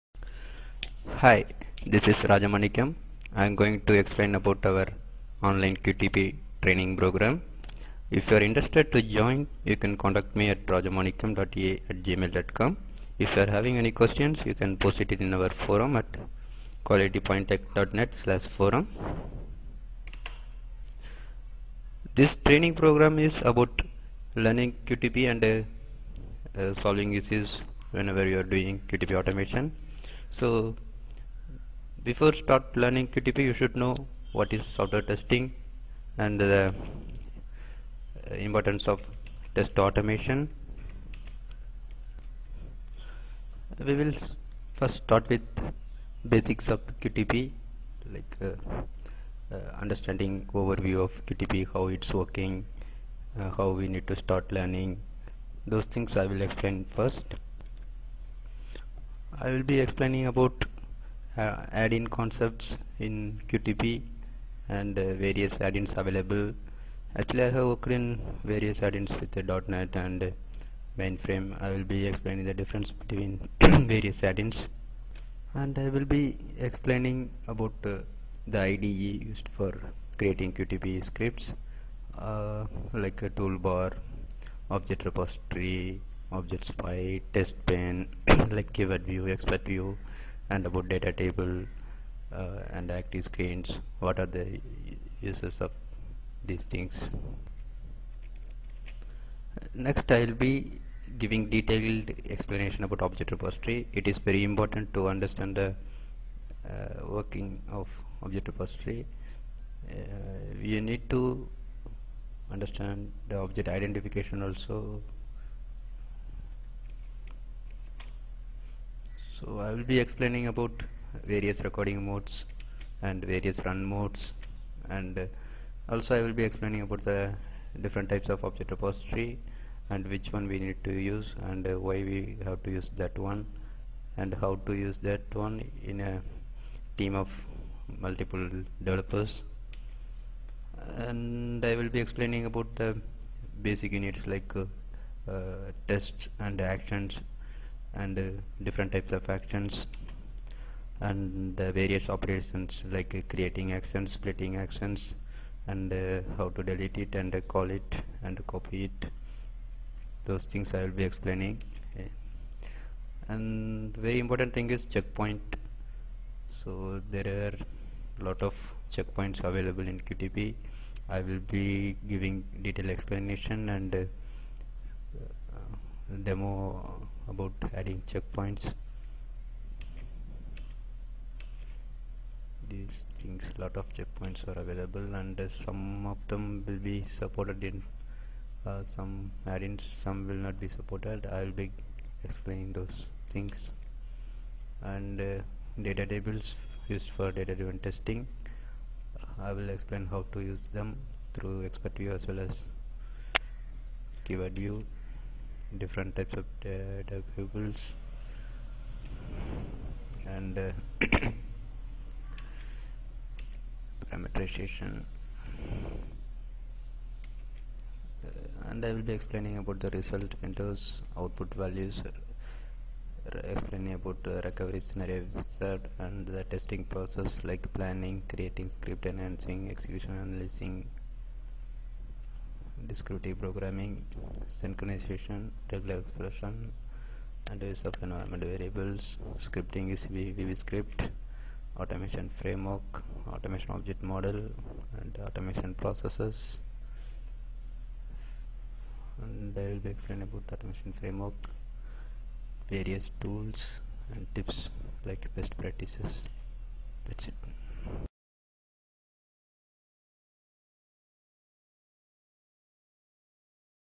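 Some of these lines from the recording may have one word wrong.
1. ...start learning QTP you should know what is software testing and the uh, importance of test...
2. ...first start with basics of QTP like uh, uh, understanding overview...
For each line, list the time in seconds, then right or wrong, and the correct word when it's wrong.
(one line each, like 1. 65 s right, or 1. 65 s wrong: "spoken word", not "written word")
1. 32 s right
2. 44 s right.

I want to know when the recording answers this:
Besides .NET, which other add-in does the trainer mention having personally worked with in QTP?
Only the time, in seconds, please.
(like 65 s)
70 s.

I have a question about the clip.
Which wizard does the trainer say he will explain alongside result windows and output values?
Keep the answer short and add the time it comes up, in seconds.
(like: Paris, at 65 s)
recovery scenario wizard, at 224 s.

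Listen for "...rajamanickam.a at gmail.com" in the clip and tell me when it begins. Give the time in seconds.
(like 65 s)
10 s.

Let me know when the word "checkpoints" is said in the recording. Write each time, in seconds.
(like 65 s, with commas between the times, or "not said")
164 s, 168 s, 178 s, 183 s.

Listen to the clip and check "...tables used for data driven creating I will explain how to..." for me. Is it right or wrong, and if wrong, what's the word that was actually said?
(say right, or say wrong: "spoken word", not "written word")
wrong: "testing", not "creating".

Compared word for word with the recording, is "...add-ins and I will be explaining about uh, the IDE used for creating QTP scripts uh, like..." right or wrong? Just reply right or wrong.
right.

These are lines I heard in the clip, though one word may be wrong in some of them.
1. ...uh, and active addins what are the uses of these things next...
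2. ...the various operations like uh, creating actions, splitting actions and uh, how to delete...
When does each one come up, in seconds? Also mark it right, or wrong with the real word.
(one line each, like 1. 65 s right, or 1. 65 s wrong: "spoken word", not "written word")
1. 92 s wrong: "screens", not "addins"
2. 151 s right.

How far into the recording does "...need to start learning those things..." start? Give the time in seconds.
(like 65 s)
53 s.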